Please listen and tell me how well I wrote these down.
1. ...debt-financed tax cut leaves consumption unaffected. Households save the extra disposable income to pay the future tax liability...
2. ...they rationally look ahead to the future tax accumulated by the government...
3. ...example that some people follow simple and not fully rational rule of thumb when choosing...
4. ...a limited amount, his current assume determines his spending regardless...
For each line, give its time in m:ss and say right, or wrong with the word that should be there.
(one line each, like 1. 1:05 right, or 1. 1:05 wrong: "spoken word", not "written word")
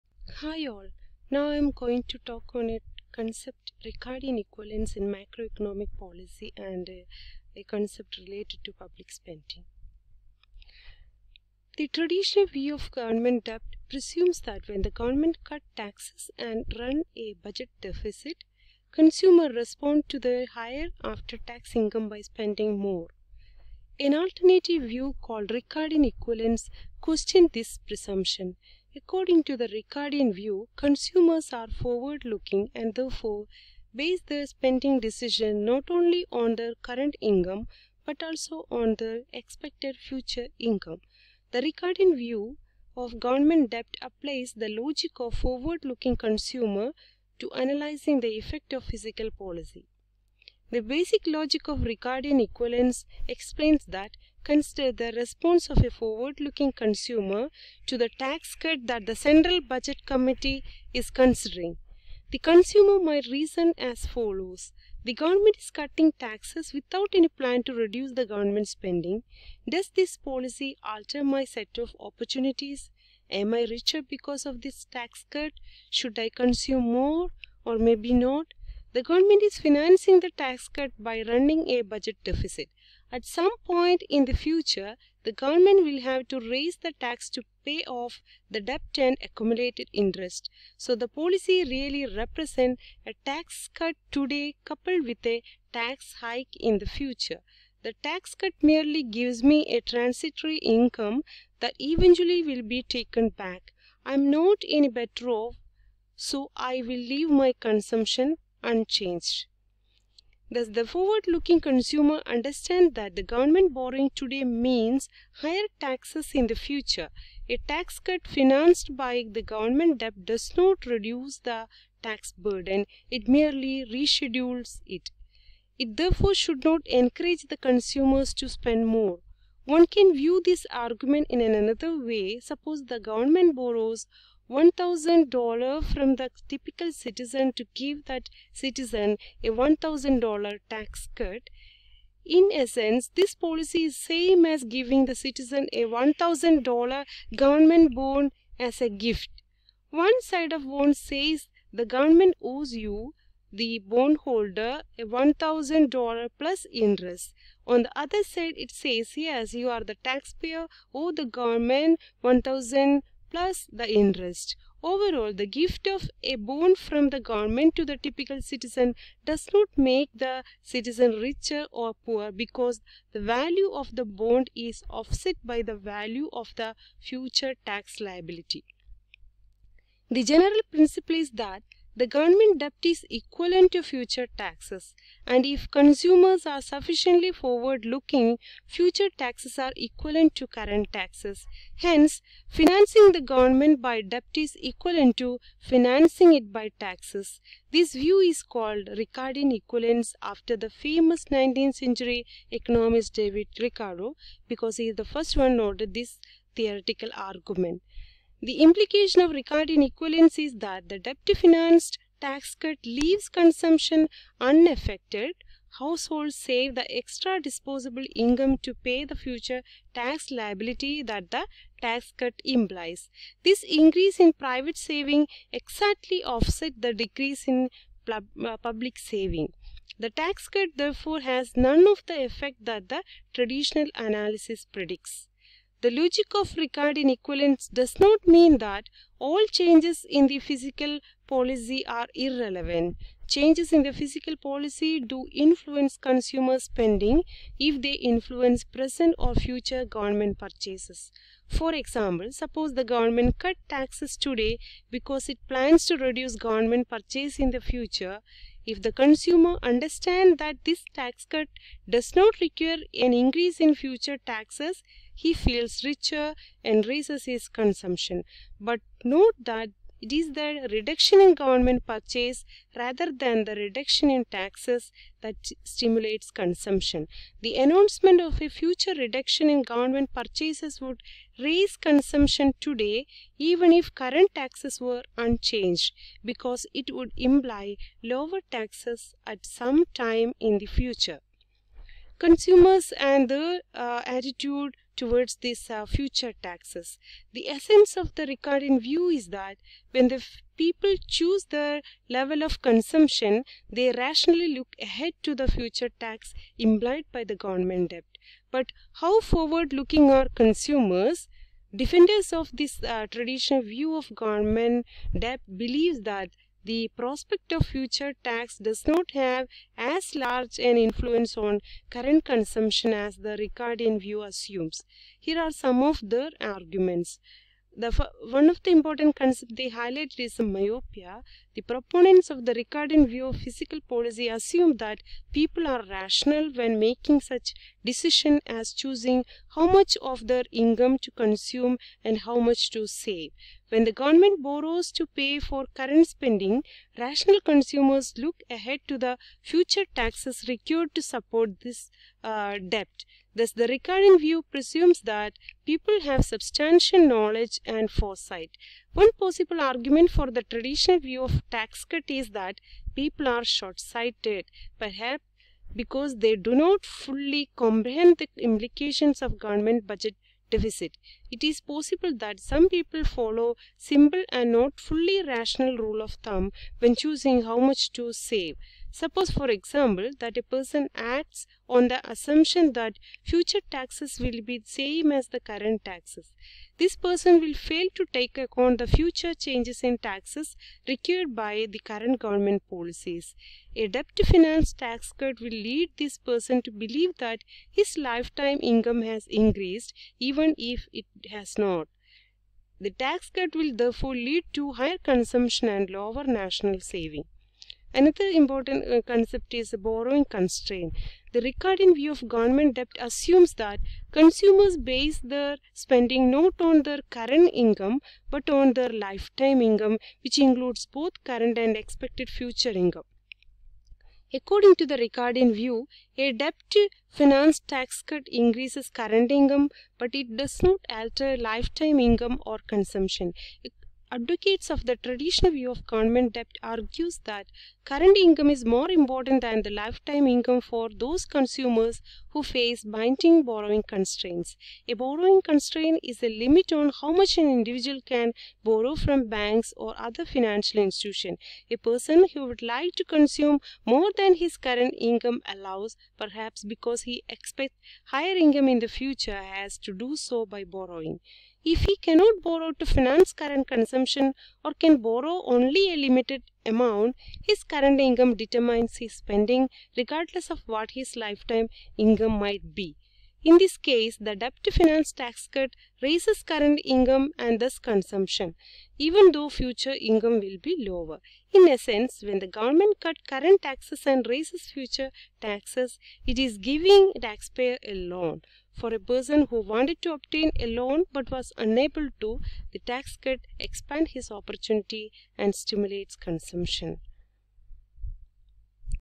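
1. 3:30 right
2. 5:03 wrong: "implied", not "accumulated"
3. 6:11 wrong: "possible", not "example"
4. 7:45 wrong: "income", not "assume".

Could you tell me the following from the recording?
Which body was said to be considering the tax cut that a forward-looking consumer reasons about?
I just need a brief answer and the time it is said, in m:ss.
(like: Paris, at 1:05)
Central Budget Committee, at 0:59.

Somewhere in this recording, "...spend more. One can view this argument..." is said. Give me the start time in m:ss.
2:08.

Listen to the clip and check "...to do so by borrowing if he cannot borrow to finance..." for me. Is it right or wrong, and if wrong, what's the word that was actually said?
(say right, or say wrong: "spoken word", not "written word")
right.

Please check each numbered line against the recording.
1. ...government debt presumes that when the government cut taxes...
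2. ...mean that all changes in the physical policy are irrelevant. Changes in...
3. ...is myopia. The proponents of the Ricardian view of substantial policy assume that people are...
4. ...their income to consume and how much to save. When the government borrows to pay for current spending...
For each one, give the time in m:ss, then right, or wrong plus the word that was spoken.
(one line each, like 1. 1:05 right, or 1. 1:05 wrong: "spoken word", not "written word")
1. 0:12 right
2. 3:58 right
3. 5:30 wrong: "physical", not "substantial"
4. 5:40 right.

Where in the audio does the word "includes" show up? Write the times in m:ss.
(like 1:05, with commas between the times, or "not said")
7:00.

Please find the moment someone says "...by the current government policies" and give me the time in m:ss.
6:31.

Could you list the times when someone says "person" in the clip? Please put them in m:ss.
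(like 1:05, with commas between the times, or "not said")
6:20, 6:26, 6:36, 7:31, 8:08.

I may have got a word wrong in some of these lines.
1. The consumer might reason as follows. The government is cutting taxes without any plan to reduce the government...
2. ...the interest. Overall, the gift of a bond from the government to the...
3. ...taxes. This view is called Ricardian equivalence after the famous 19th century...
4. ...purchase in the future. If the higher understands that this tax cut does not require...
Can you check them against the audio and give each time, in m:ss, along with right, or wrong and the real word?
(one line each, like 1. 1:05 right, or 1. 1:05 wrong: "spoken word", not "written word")
1. 1:02 right
2. 2:43 right
3. 3:16 right
4. 4:16 wrong: "consumer", not "higher".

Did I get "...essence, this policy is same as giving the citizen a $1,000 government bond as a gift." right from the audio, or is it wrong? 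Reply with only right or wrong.
right.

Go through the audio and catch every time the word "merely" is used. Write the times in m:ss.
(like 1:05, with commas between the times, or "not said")
1:38, 2:03.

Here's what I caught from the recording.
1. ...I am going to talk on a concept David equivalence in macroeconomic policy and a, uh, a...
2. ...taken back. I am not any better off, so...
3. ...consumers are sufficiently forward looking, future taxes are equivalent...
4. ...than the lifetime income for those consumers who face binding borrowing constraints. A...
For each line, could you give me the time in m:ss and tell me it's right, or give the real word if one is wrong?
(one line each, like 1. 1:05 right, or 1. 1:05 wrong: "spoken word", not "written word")
1. 0:01 wrong: "Ricardian", not "David"
2. 1:42 right
3. 3:05 right
4. 7:19 right.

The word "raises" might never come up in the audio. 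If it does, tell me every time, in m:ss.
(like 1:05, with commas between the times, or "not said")
1:26, 4:26, 4:41, 7:55, 8:04.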